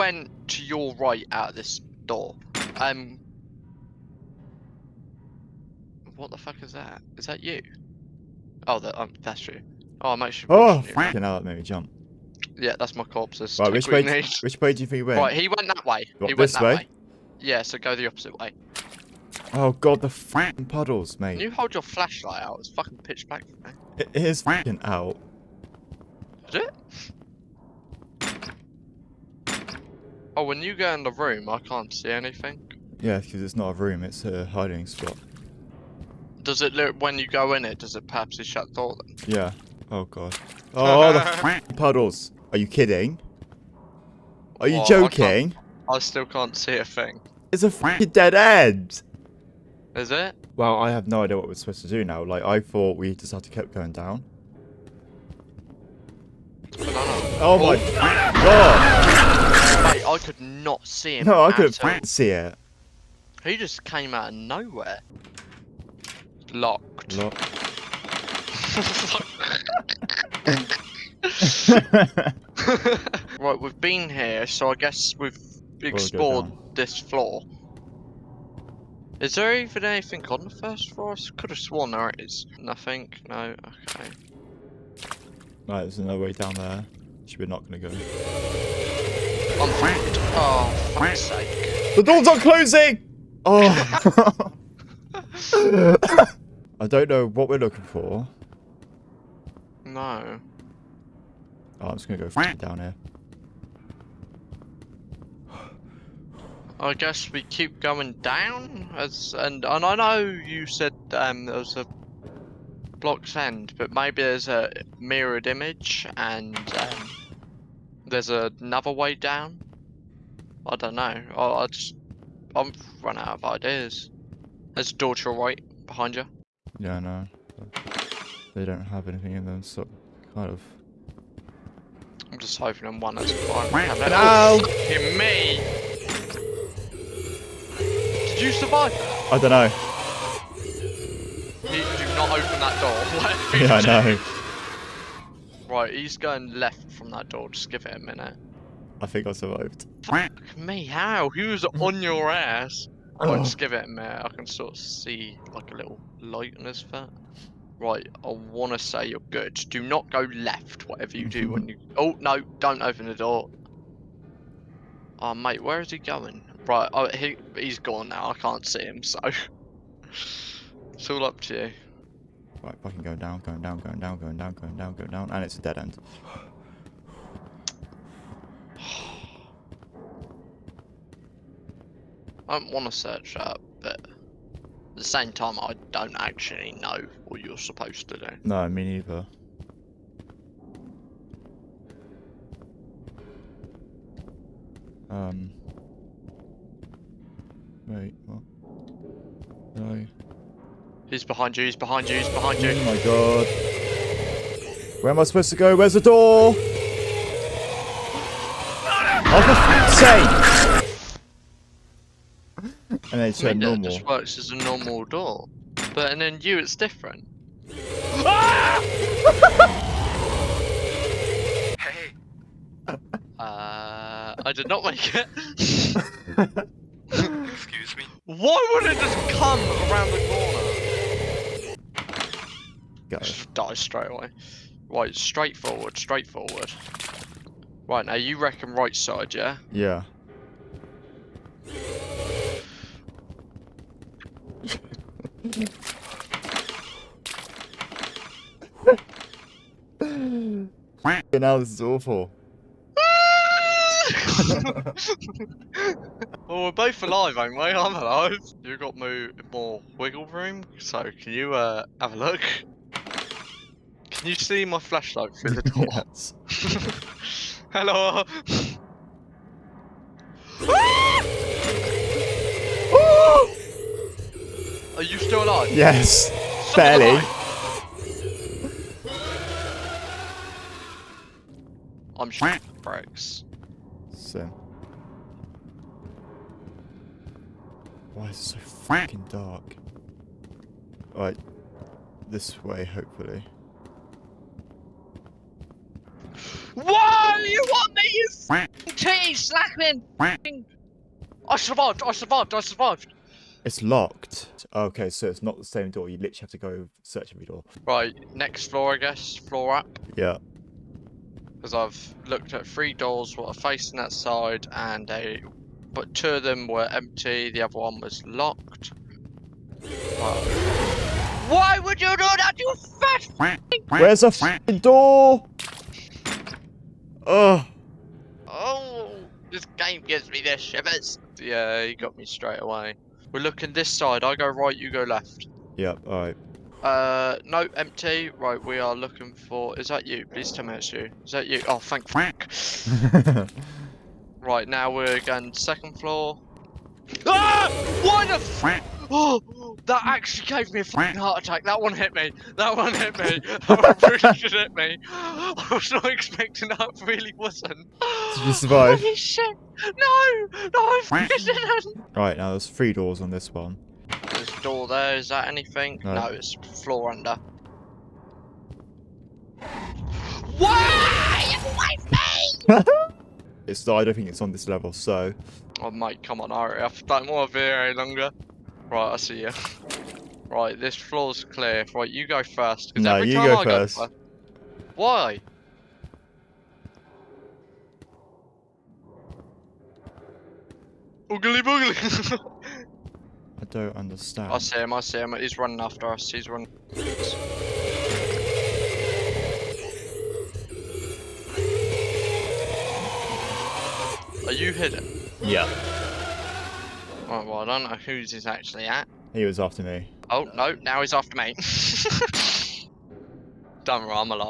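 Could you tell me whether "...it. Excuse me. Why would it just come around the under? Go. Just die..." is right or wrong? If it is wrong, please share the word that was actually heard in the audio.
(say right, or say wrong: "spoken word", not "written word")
wrong: "corner", not "under".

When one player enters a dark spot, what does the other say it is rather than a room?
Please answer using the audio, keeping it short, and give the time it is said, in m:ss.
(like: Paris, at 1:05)
a hiding spot, at 0:34.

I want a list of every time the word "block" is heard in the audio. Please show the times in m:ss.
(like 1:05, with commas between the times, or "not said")
1:52.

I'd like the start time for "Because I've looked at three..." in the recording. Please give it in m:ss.
5:11.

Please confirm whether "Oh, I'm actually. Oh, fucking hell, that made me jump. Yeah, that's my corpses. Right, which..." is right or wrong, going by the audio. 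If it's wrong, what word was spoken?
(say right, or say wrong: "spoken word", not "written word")
right.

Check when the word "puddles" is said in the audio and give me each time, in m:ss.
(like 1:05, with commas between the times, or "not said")
0:20, 0:41.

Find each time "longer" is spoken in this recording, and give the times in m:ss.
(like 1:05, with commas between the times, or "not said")
6:17.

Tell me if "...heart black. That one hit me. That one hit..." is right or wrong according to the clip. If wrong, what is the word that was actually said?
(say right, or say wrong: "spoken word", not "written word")
wrong: "attack", not "black".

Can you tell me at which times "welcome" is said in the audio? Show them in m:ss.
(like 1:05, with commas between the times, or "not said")
not said.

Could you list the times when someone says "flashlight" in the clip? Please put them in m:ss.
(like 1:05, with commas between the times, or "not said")
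0:21, 4:24.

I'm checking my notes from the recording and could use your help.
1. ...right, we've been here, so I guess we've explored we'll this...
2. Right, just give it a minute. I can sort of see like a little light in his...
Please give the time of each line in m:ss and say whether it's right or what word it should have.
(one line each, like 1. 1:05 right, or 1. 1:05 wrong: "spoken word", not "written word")
1. 1:13 right
2. 2:33 right.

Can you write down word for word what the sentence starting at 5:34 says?
I go right, you go left.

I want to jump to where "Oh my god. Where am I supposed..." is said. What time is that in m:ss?
3:22.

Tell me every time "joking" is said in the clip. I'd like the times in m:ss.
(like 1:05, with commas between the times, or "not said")
0:44.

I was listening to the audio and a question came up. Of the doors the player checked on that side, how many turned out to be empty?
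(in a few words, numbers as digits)
2.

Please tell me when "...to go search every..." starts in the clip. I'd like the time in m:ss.
5:06.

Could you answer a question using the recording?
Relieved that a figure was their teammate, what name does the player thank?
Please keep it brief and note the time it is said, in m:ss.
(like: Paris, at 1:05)
Frank, at 5:41.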